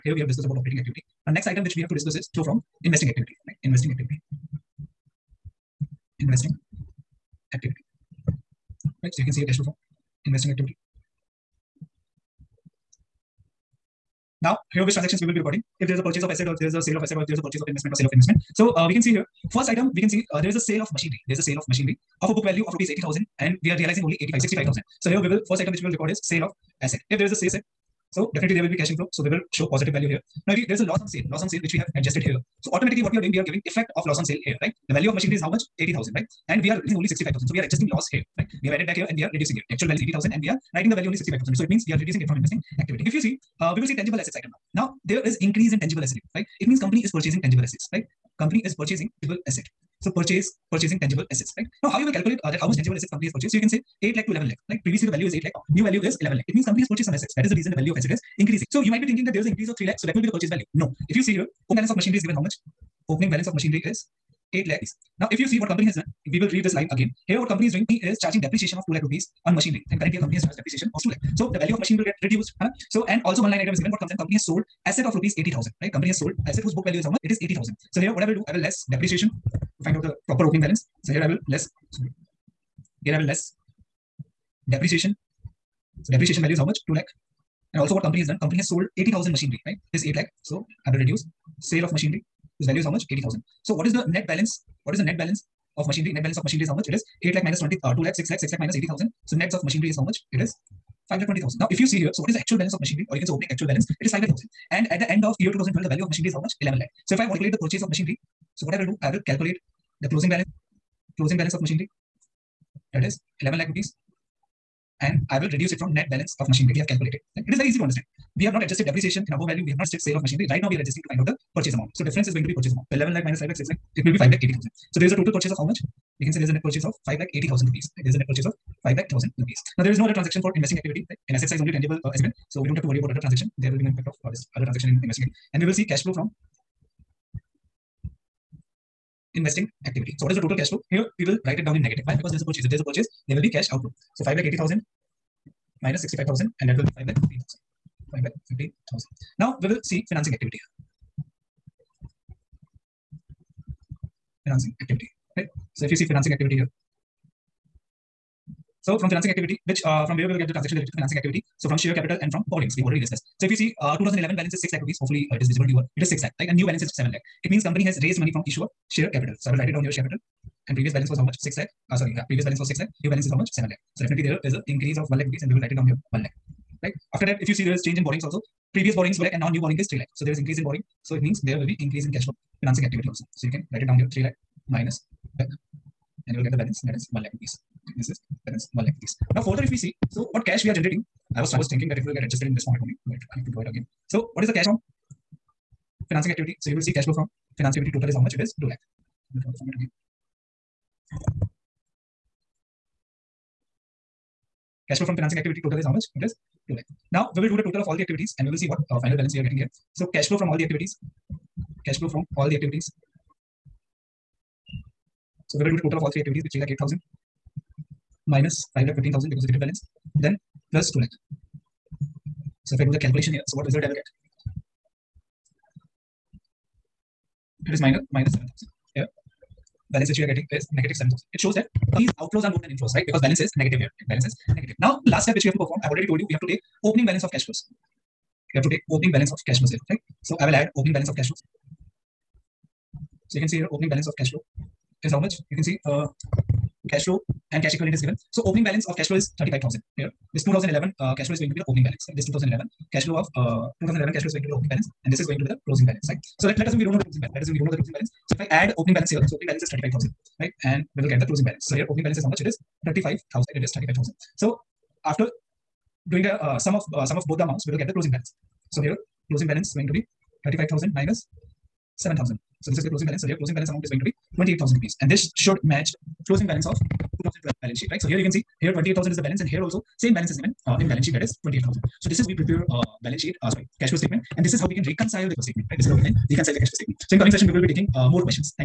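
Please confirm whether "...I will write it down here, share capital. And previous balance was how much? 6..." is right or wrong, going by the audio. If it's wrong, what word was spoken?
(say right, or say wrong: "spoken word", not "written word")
right.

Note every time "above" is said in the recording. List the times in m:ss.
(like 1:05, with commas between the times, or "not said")
1:59.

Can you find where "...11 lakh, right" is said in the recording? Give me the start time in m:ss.
0:54.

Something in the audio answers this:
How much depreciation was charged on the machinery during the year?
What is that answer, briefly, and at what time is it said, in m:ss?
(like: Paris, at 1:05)
2 lakh rupees, at 1:08.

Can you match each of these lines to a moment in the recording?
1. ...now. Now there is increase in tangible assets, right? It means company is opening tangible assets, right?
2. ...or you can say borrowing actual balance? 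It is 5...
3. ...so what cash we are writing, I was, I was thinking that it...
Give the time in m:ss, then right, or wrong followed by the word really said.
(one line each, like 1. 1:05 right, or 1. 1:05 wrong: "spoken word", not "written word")
1. 0:44 wrong: "purchasing", not "opening"
2. 1:43 wrong: "opening", not "borrowing"
3. 3:10 wrong: "generating", not "writing".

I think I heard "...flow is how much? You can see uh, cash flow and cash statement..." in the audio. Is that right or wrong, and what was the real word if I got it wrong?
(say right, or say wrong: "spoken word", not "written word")
wrong: "equivalent", not "statement".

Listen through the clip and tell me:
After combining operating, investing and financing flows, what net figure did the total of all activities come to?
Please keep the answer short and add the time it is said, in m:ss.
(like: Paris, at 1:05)
negative 7,000, at 3:50.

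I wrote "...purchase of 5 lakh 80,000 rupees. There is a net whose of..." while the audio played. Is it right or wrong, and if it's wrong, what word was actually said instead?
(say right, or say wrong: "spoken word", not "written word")
wrong: "purchase", not "whose".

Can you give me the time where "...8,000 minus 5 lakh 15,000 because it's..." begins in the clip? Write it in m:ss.
3:36.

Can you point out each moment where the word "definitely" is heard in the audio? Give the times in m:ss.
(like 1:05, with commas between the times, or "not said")
0:28, 2:54.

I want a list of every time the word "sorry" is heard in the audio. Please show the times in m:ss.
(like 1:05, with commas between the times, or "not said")
1:21, 2:51, 4:43.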